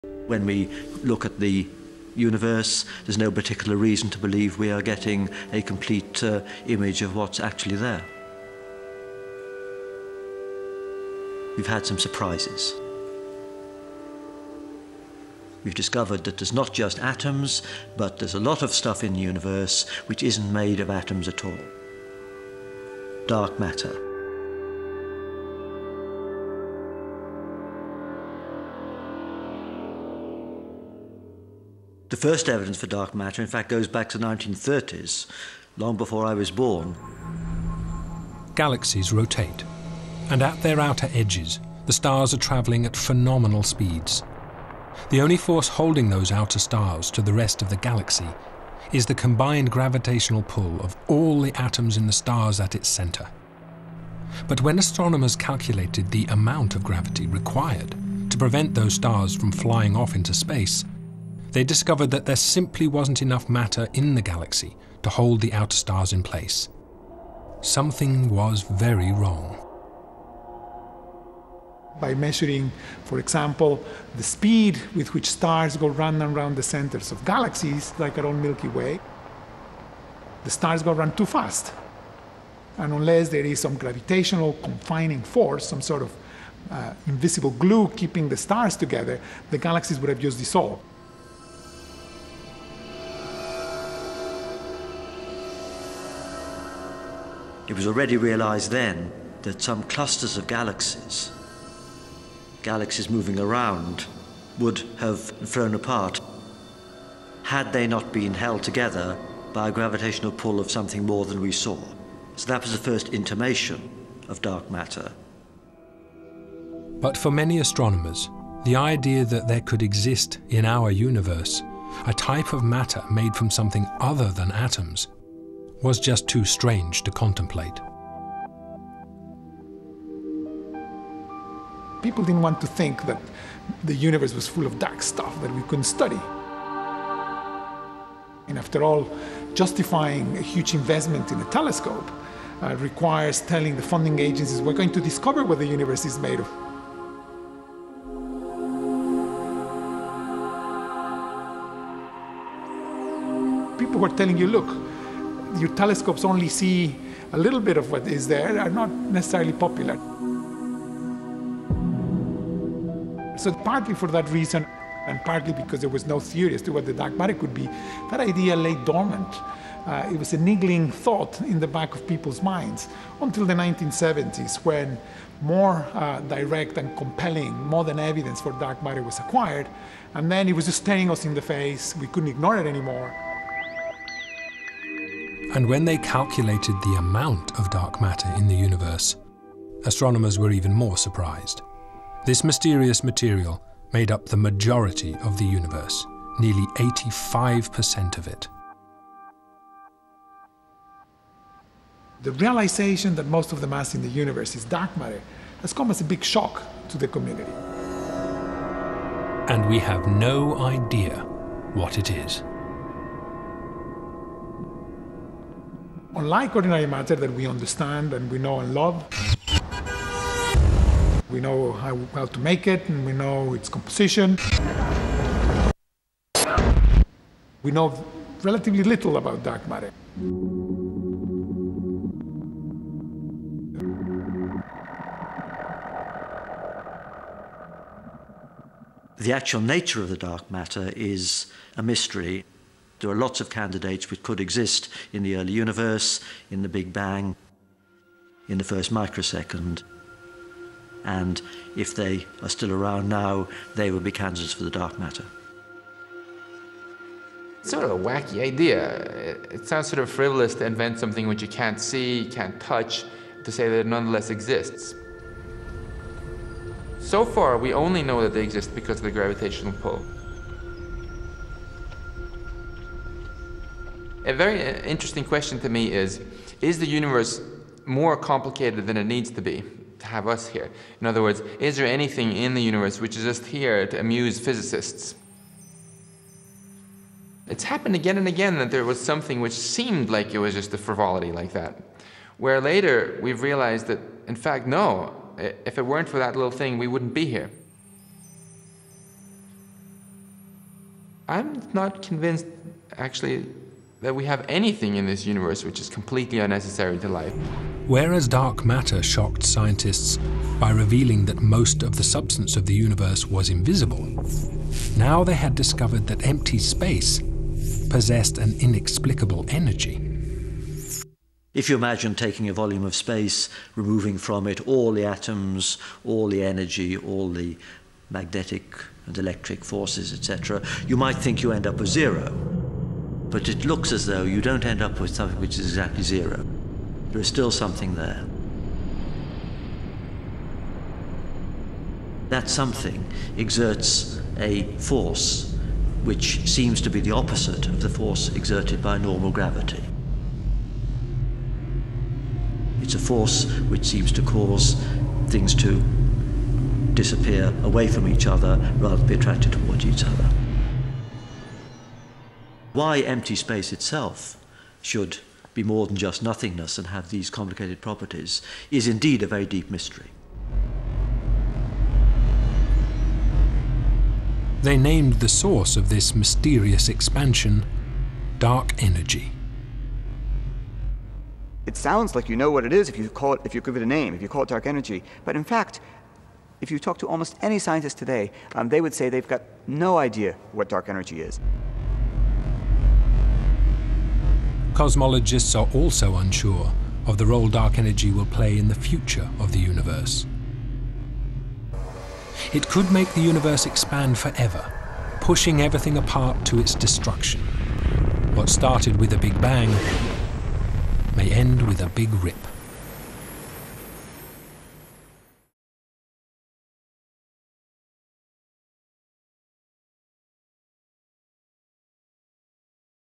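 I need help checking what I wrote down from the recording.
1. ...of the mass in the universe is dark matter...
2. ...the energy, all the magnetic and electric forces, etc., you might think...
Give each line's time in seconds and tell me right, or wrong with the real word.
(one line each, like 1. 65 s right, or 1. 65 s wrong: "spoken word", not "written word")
1. 203 s right
2. 326 s right.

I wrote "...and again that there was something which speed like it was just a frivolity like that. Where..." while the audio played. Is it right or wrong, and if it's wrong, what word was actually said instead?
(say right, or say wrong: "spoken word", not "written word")
wrong: "seemed", not "speed".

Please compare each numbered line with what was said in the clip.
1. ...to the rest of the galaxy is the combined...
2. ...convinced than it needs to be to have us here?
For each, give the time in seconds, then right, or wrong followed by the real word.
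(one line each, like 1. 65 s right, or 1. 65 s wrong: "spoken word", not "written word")
1. 47 s right
2. 278 s wrong: "complicated", not "convinced".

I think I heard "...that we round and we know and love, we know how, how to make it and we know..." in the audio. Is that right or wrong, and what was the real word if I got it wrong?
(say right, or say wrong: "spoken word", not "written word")
wrong: "understand", not "round".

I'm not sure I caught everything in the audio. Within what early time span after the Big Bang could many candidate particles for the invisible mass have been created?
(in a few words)
first microsecond.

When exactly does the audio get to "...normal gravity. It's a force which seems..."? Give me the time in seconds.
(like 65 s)
348 s.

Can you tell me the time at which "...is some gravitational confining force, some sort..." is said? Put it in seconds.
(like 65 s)
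83 s.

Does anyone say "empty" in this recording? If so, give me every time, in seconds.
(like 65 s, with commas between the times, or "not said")
316 s, 363 s.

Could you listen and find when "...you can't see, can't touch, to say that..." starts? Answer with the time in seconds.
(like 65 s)
261 s.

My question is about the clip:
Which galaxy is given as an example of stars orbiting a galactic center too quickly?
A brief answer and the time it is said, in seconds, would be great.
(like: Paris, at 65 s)
Milky Way, at 78 s.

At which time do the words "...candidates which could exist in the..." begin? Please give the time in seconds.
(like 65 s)
243 s.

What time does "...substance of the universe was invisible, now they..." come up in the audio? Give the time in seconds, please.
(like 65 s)
312 s.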